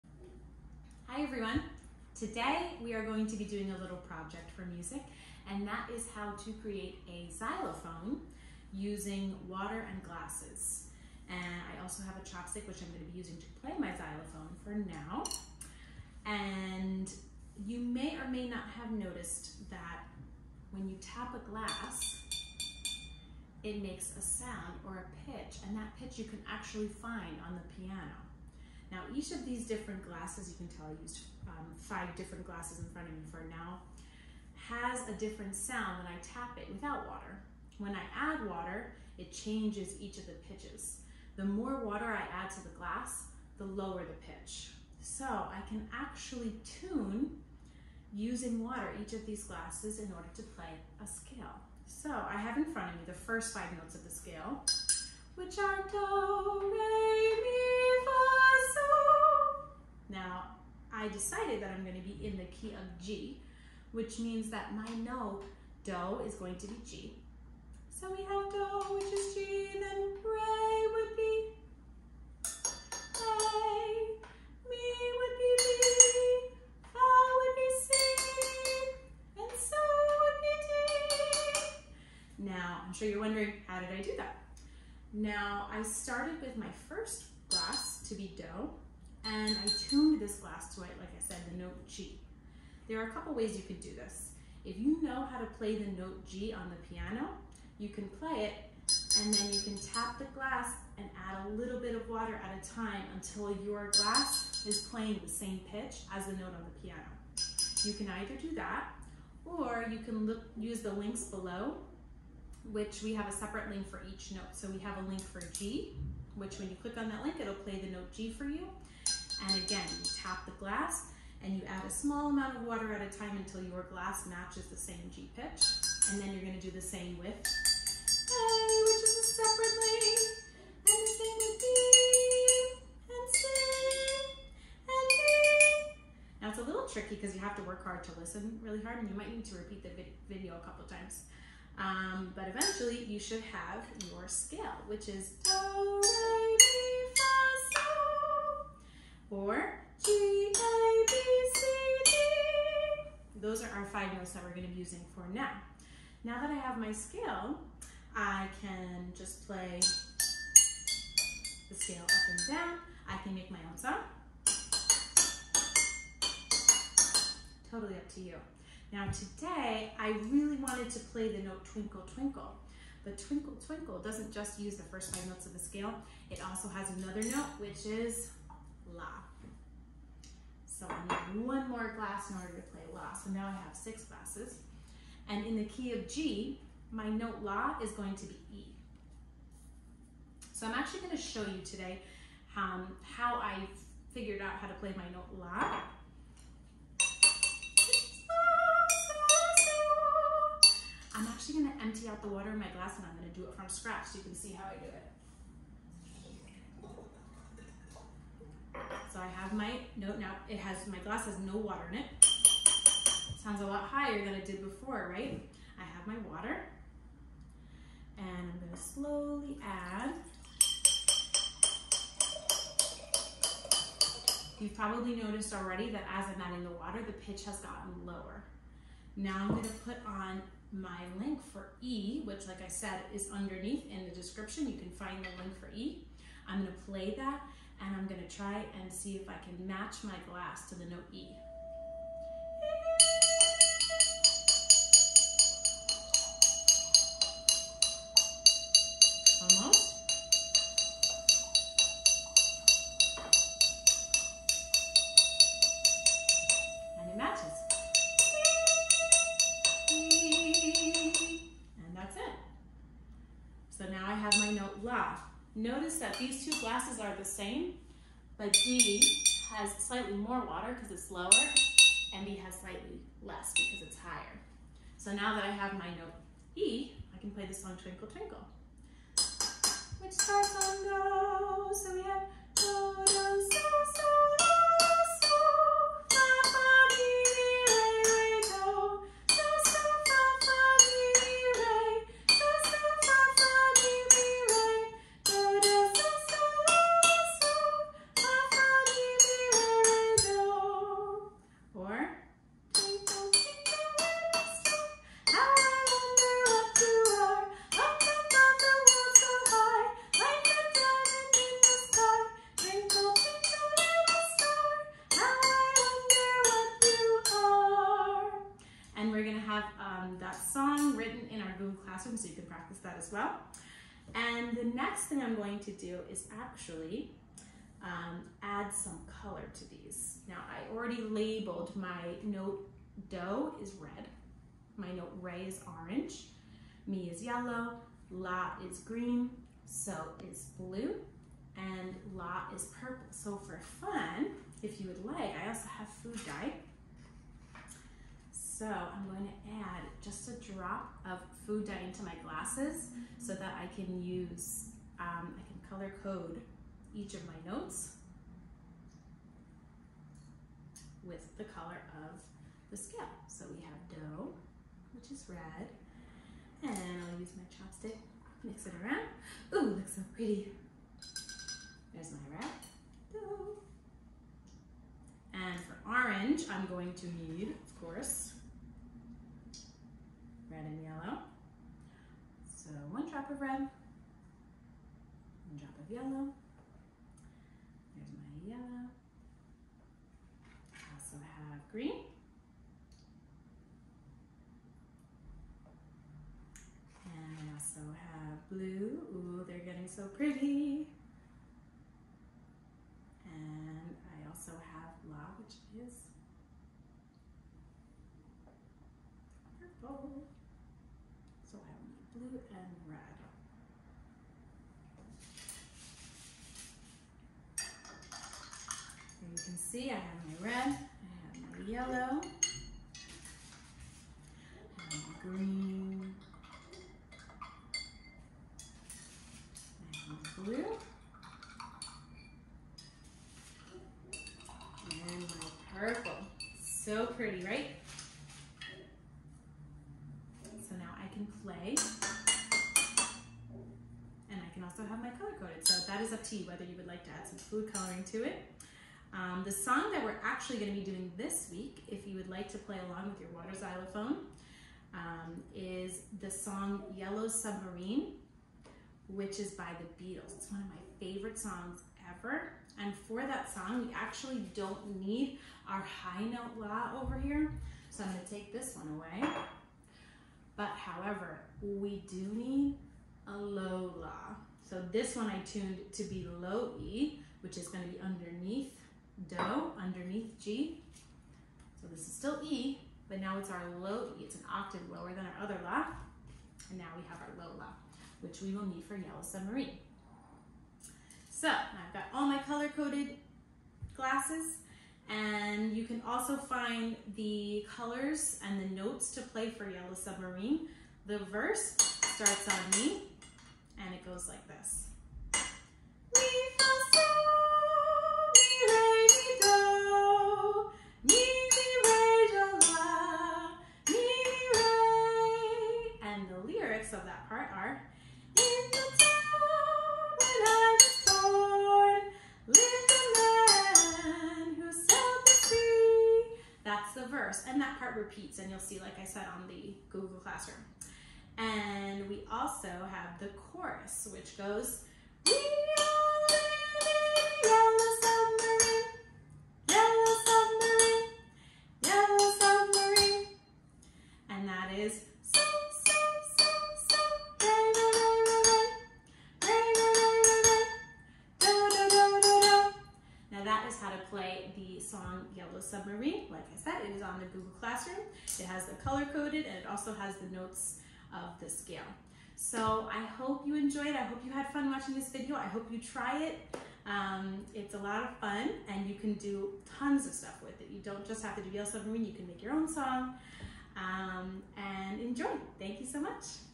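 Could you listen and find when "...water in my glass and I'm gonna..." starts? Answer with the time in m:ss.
3:22.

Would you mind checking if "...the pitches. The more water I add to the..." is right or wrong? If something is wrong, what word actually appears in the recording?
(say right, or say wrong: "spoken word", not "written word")
right.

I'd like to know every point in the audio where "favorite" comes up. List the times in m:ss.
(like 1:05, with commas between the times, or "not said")
7:40.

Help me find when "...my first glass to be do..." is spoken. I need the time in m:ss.
1:26.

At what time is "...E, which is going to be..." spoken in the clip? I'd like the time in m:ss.
7:56.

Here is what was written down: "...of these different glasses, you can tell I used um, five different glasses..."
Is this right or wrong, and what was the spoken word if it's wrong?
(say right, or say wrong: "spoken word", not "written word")
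right.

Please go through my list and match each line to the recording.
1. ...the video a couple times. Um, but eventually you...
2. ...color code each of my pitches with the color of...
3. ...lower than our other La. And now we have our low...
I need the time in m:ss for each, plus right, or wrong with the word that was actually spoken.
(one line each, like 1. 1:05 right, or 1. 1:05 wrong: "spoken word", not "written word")
1. 2:19 right
2. 5:55 wrong: "notes", not "pitches"
3. 8:04 right.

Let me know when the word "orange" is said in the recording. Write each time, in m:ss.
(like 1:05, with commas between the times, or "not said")
5:35, 6:15.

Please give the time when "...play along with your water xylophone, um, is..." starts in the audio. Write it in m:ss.
7:32.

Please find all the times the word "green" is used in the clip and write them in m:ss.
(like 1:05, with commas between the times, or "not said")
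5:38, 6:31, 7:05.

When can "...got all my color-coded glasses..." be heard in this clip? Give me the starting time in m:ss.
8:11.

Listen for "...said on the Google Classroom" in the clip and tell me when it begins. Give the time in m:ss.
8:49.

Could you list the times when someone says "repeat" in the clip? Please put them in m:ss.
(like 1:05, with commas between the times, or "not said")
2:19, 8:47.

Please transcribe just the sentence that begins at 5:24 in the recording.
And the next thing I'm going to do is actually um, add some color to these.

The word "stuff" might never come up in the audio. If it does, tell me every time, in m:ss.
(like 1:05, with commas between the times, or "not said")
9:30.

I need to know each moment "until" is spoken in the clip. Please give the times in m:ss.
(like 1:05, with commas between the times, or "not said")
1:43, 2:03.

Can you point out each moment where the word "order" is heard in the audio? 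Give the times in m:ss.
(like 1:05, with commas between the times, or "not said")
0:50, 3:02.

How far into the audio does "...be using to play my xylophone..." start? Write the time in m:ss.
0:13.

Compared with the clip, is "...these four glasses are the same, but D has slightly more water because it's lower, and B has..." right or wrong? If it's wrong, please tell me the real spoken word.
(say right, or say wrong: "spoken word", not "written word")
wrong: "two", not "four".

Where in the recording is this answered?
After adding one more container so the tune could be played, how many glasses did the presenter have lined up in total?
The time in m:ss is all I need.
3:03.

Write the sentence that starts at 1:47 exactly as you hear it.
You can either do that or you can look, use the links below which we have a separate link for each note.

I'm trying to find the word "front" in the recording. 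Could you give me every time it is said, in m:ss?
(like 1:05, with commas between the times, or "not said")
0:32, 0:52.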